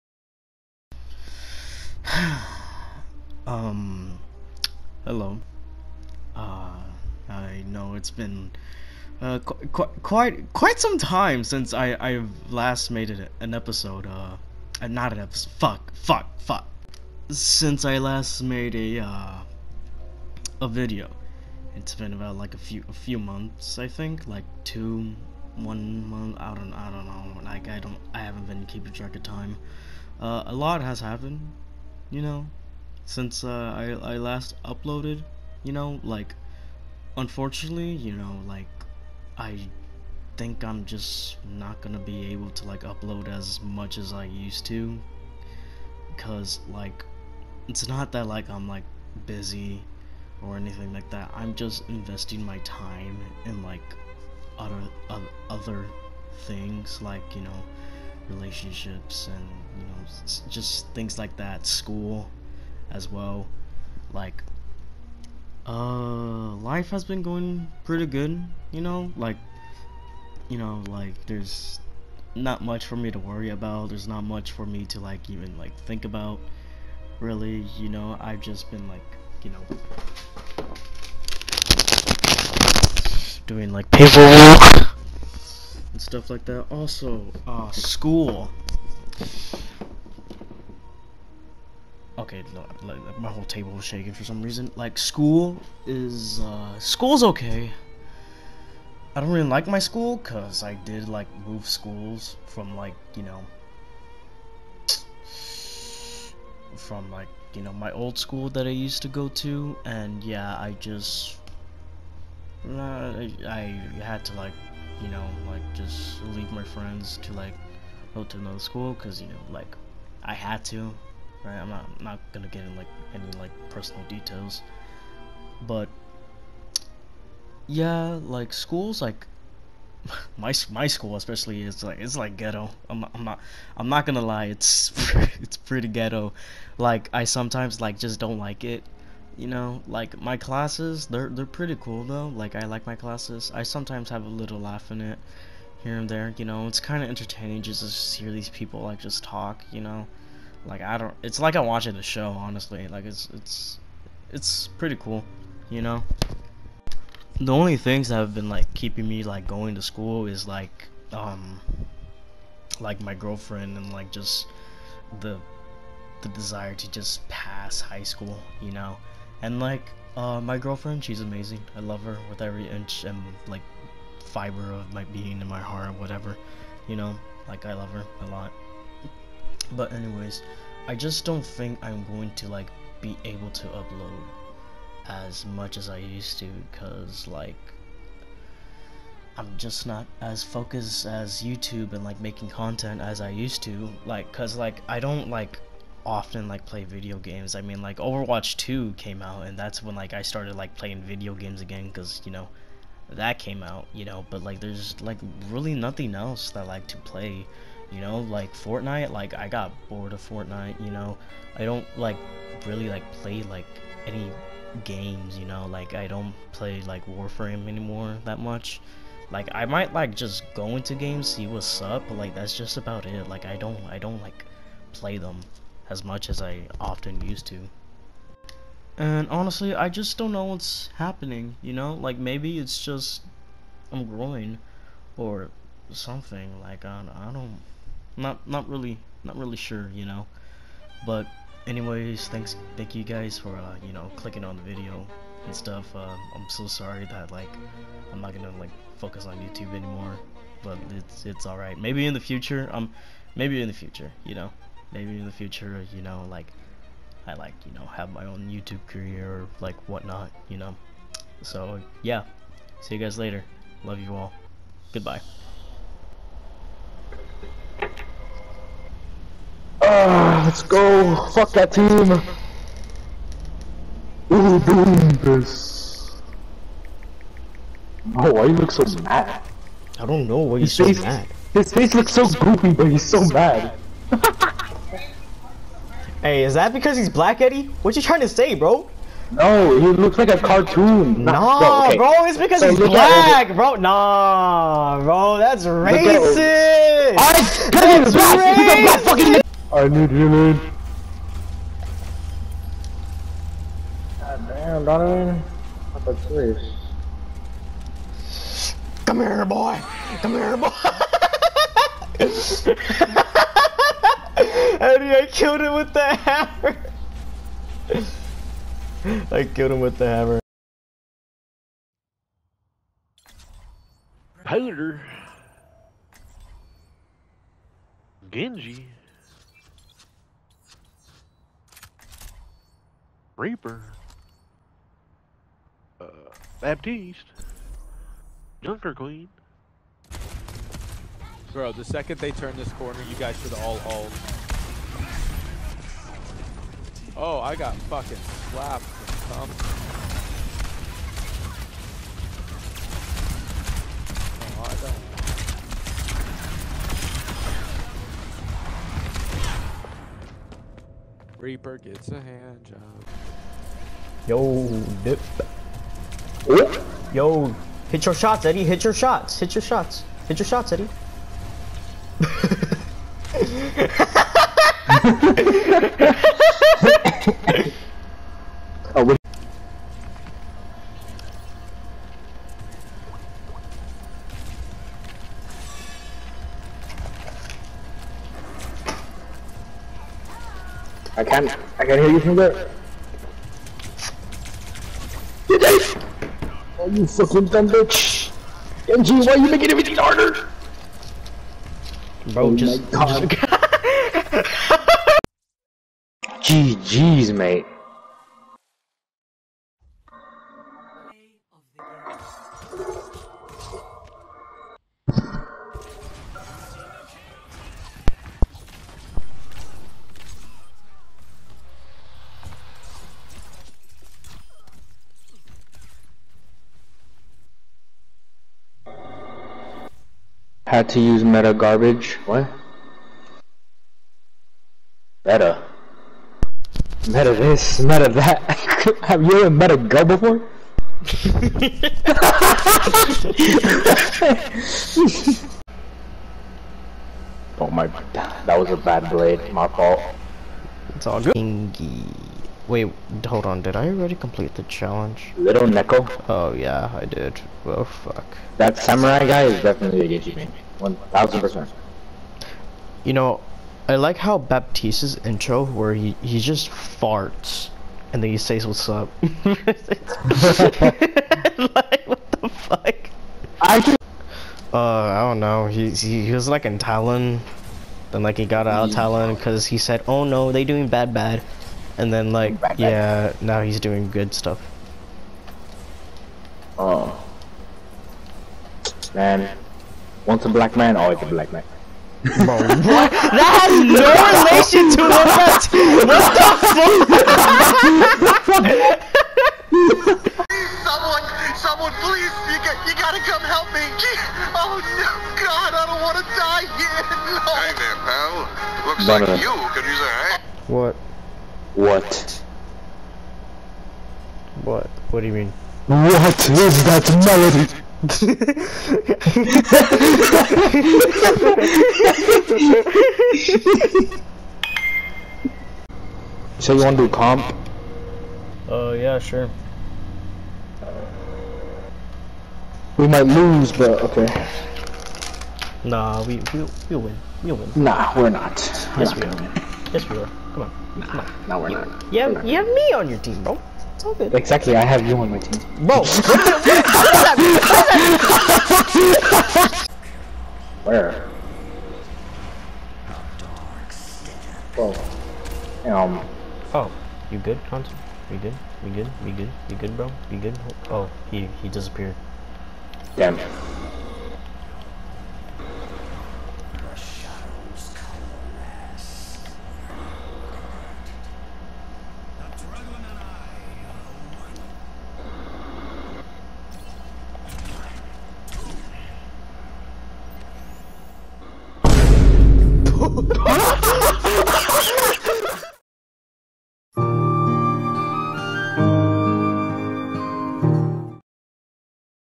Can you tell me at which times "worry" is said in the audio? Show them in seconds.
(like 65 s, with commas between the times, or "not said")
73 s.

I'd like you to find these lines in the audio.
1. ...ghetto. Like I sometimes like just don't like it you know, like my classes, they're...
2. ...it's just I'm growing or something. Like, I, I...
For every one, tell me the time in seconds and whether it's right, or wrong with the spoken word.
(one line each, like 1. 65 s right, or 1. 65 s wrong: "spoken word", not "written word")
1. 135 s right
2. 232 s right.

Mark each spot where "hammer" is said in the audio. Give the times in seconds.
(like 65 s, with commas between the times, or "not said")
316 s, 320 s.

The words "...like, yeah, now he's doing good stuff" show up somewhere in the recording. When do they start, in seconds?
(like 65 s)
482 s.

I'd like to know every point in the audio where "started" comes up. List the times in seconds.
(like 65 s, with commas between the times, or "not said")
200 s.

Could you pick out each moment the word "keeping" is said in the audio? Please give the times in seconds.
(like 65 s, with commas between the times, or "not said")
28 s, 158 s.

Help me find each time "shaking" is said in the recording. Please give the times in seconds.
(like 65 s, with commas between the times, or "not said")
93 s.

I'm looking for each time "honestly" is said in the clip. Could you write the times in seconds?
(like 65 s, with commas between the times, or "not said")
152 s, 229 s.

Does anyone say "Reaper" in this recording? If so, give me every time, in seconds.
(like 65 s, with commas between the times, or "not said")
333 s, 361 s.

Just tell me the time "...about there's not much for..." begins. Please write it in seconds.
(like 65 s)
73 s.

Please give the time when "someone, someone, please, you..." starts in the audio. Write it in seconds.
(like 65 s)
500 s.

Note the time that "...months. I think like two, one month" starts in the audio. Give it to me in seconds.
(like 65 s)
23 s.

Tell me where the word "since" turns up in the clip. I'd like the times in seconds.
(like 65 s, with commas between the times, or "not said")
11 s, 17 s, 33 s.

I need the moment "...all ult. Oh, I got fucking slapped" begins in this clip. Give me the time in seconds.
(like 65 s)
343 s.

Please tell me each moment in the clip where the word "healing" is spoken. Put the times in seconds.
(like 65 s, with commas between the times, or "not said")
300 s.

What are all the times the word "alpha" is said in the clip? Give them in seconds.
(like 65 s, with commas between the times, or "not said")
not said.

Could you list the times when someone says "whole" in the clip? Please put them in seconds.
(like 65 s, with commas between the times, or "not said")
93 s.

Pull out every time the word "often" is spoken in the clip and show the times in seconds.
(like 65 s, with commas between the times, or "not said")
196 s, 226 s.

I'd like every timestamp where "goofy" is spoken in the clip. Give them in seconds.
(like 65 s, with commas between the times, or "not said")
282 s.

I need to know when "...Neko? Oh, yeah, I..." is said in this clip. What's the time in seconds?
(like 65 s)
455 s.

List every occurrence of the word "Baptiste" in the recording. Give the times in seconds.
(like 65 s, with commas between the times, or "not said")
336 s, 464 s.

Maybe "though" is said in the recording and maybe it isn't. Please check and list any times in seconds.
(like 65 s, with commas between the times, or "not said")
142 s.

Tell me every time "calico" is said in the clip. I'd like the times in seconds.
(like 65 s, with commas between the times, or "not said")
not said.